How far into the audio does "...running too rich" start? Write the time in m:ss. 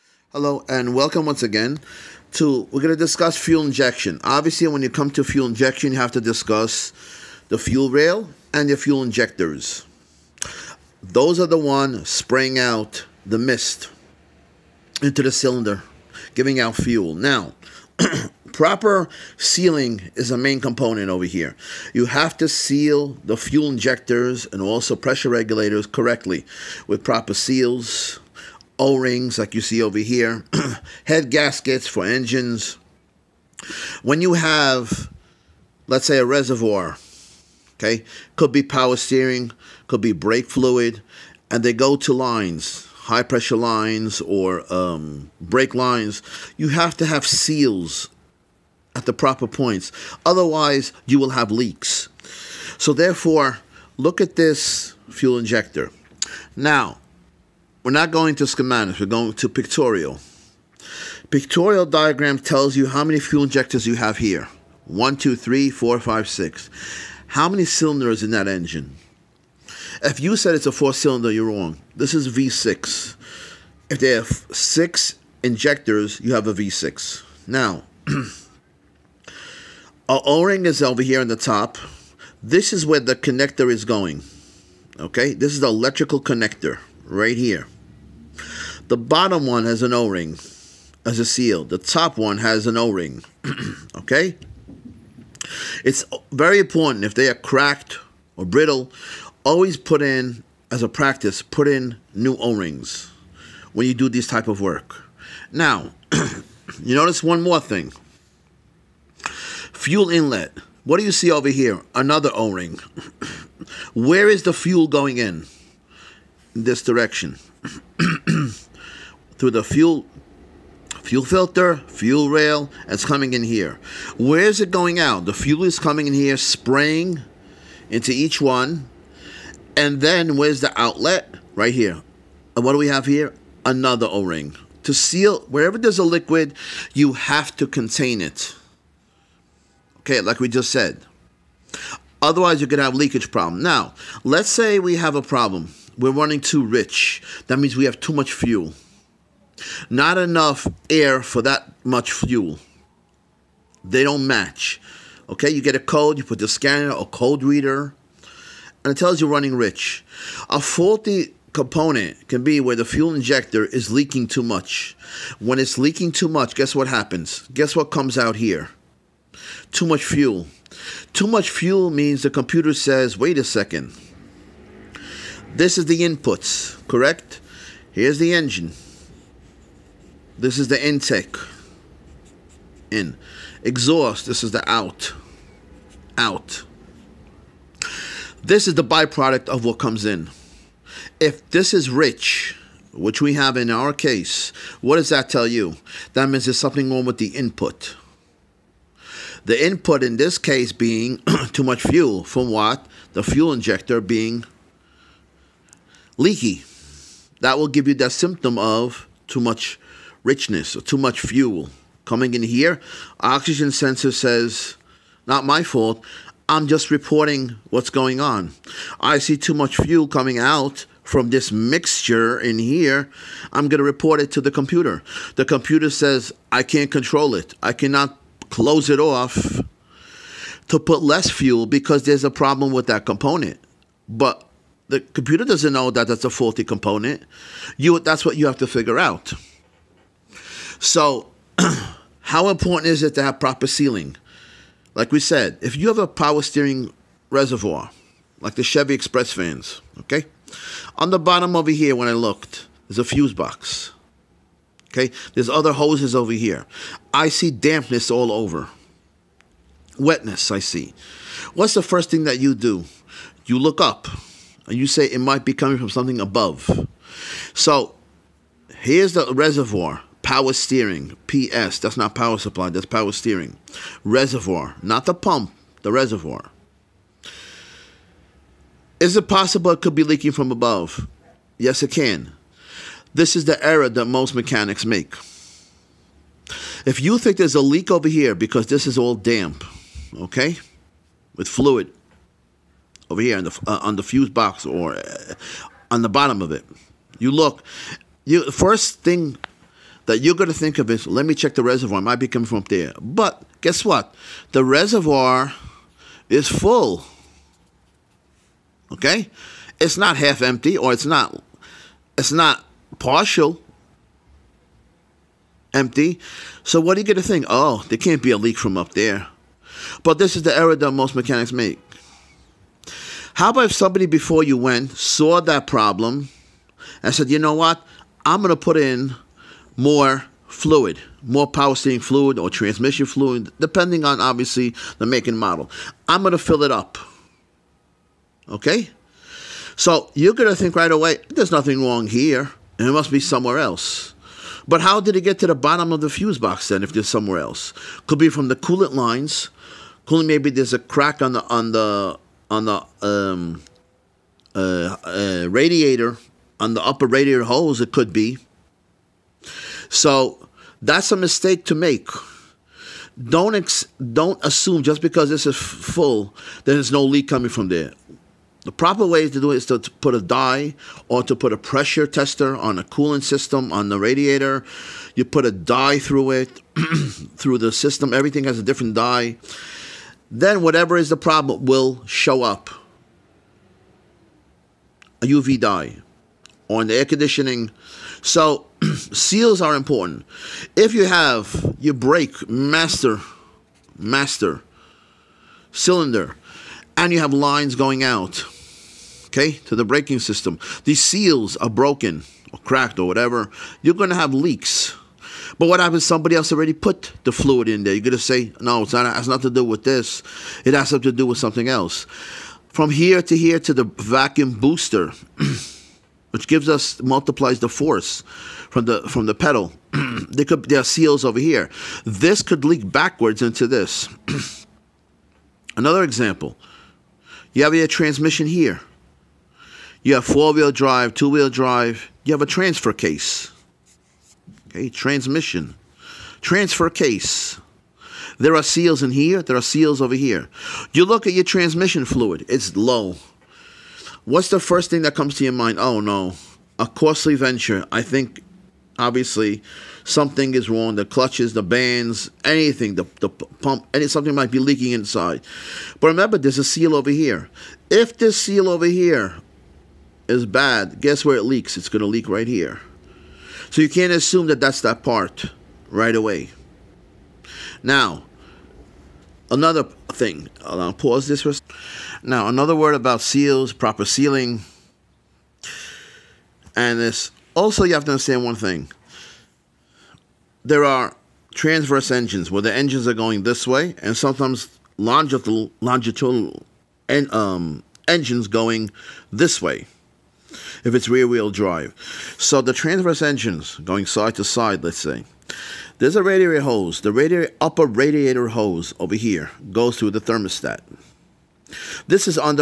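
2:26.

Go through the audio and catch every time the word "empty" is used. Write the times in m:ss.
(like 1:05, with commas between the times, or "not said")
5:10, 5:15.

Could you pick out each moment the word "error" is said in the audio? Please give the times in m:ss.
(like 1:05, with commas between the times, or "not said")
4:43, 5:20.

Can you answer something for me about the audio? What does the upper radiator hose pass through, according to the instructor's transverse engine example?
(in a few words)
The thermostat.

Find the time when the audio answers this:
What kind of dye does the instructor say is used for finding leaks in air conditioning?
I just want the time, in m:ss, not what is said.
6:25.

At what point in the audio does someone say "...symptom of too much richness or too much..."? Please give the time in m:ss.
3:28.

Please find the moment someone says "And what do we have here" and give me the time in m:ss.
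2:12.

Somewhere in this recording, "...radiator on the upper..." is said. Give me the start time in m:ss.
5:55.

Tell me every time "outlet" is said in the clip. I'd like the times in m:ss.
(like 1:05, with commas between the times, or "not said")
2:10.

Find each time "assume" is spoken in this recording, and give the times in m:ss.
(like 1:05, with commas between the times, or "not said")
6:04, 7:44.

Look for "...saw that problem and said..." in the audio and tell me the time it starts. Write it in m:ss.
5:24.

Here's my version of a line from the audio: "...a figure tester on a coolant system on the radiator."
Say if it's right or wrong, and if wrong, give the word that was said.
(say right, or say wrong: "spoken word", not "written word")
wrong: "pressure", not "figure".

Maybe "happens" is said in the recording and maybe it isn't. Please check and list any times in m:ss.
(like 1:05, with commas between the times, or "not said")
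2:46, 6:45.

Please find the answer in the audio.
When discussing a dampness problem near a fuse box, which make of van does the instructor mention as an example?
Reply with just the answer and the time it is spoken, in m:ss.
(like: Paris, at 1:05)
Chevy Express, at 4:08.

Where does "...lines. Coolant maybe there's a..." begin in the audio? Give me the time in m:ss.
5:48.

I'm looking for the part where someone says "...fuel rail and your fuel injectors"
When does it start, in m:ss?
0:07.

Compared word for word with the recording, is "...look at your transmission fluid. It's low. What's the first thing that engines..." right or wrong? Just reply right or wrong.
wrong.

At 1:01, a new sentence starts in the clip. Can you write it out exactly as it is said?
Pictorial diagram tells you how many fuel injectors you have here.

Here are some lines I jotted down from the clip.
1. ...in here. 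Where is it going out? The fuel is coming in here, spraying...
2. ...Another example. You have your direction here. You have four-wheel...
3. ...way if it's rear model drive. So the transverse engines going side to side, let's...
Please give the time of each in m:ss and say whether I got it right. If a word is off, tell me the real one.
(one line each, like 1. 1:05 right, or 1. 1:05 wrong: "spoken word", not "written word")
1. 2:03 right
2. 7:05 wrong: "transmission", not "direction"
3. 8:09 wrong: "wheel", not "model".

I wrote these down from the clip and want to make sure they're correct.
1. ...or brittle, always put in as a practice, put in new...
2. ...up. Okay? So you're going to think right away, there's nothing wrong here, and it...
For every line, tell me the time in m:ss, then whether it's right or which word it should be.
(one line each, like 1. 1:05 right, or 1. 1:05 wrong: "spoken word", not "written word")
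1. 1:38 right
2. 5:36 right.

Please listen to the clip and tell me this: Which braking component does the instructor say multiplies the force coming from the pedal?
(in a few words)
Vacuum booster.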